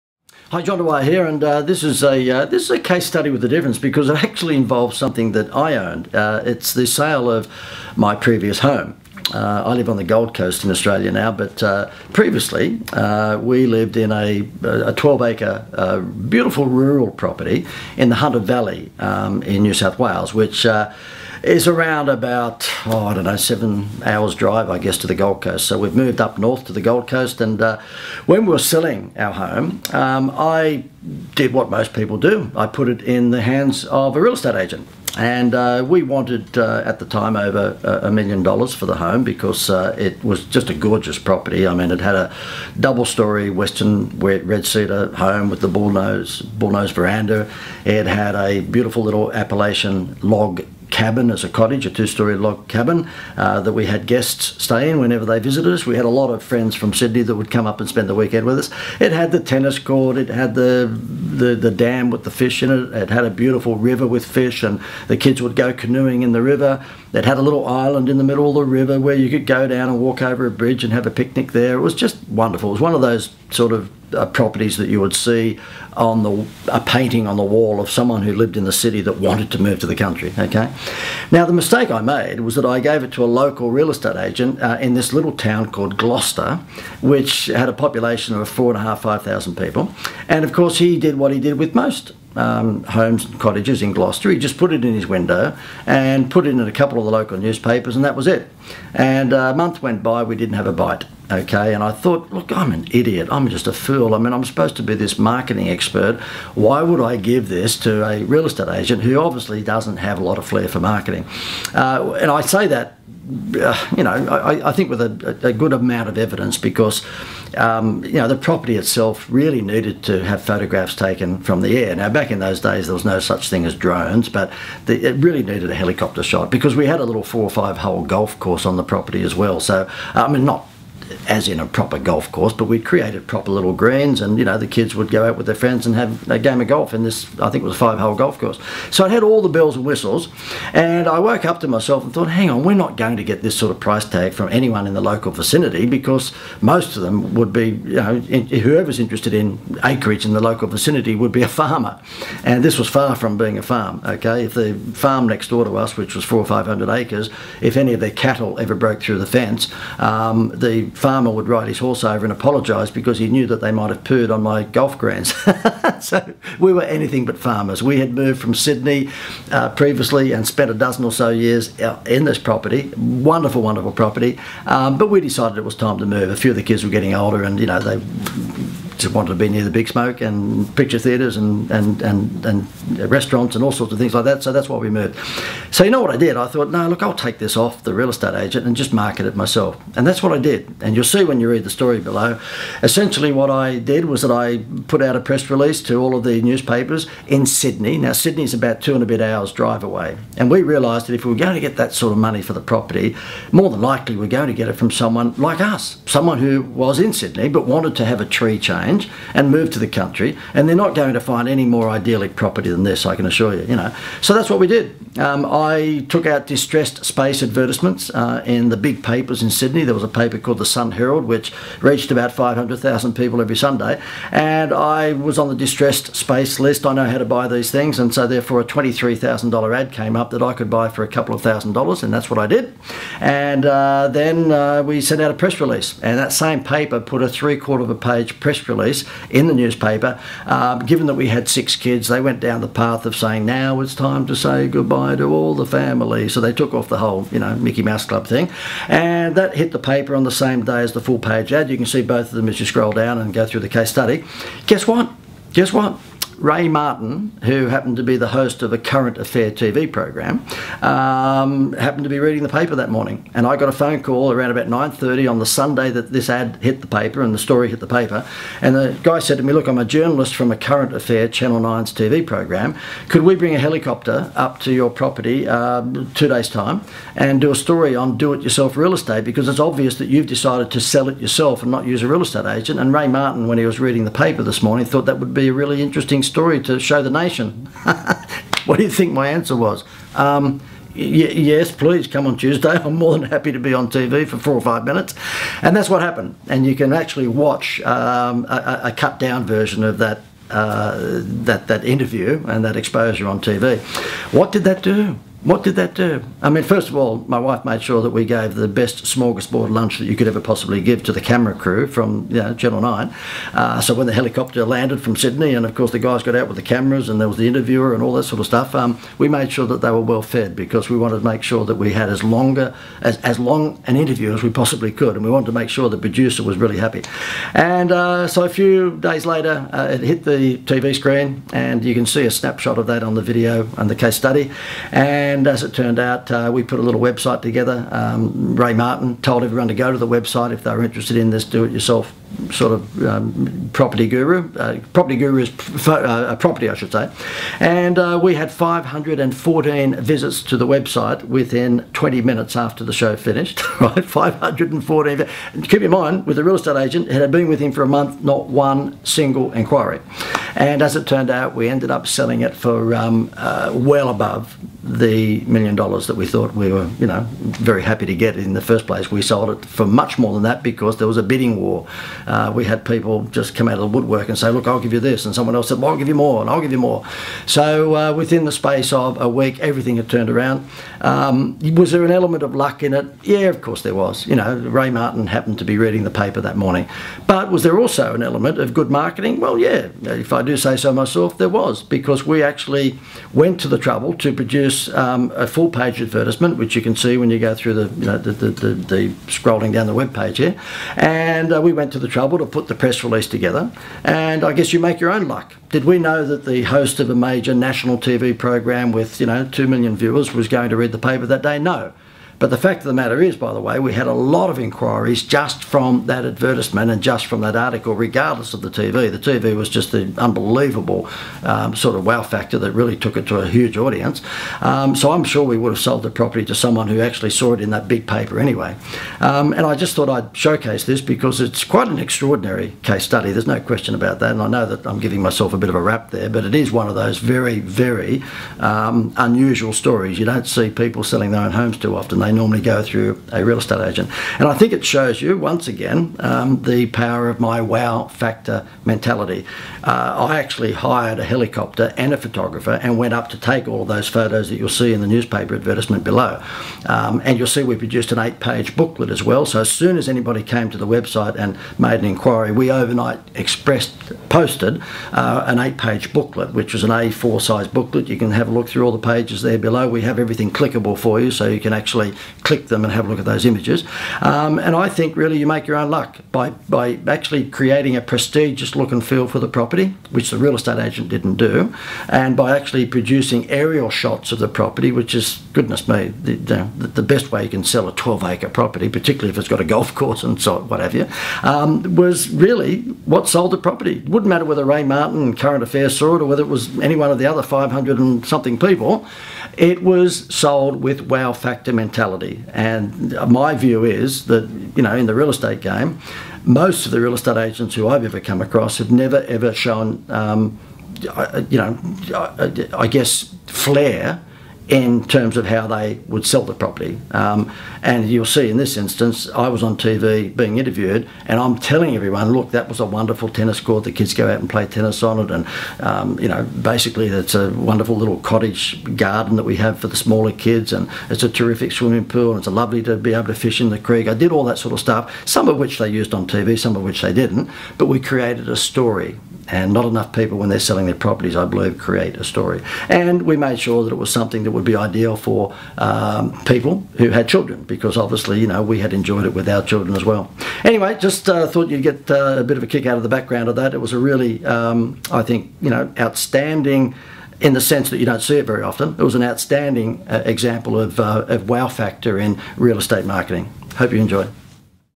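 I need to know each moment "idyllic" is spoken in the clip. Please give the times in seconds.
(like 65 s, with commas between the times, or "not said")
211 s.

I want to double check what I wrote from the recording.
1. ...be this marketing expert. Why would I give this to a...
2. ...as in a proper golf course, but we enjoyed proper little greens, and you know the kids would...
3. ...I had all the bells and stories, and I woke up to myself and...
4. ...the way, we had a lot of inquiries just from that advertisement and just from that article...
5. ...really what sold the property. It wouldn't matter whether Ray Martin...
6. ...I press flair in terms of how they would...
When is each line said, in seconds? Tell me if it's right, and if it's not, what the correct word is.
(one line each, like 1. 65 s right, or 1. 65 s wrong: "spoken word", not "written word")
1. 104 s right
2. 131 s wrong: "created", not "enjoyed"
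3. 139 s wrong: "whistles", not "stories"
4. 413 s right
5. 492 s right
6. 512 s wrong: "guess", not "press".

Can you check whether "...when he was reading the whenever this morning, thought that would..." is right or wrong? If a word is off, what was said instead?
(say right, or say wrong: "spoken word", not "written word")
wrong: "paper", not "whenever".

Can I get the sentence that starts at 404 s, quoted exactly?
And I guess you make your own luck.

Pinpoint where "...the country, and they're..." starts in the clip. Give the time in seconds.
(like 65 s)
209 s.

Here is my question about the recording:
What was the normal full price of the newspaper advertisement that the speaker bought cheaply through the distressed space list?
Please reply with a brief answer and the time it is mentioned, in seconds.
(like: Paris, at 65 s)
$23,000, at 228 s.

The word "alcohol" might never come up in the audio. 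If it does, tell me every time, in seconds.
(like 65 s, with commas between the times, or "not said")
not said.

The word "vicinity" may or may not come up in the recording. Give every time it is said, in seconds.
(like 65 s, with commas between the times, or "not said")
145 s, 150 s.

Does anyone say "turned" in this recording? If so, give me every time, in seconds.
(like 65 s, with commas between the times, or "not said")
335 s, 361 s, 380 s.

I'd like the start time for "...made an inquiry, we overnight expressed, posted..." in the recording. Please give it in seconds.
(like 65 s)
461 s.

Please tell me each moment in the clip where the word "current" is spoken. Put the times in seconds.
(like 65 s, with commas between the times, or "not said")
258 s, 270 s, 495 s.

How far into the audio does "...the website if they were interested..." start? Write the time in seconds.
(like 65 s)
339 s.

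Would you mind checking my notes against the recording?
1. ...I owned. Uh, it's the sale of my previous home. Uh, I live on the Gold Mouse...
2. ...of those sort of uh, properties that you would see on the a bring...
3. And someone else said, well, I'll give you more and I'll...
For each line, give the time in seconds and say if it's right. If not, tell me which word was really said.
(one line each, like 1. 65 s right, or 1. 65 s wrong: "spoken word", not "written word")
1. 5 s wrong: "Coast", not "Mouse"
2. 72 s wrong: "painting", not "bring"
3. 375 s right.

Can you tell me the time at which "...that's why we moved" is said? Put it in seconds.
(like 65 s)
184 s.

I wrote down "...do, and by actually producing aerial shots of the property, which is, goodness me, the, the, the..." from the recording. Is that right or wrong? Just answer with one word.
right.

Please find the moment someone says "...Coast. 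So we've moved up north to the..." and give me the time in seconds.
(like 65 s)
25 s.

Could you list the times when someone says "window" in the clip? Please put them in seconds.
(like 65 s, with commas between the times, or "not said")
95 s.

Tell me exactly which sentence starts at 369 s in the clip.
We sold it for much more than that because there was a bidding war.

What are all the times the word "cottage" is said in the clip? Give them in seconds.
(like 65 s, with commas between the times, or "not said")
51 s, 93 s, 528 s.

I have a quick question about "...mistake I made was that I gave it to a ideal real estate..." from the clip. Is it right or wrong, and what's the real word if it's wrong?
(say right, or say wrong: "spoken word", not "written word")
wrong: "local", not "ideal".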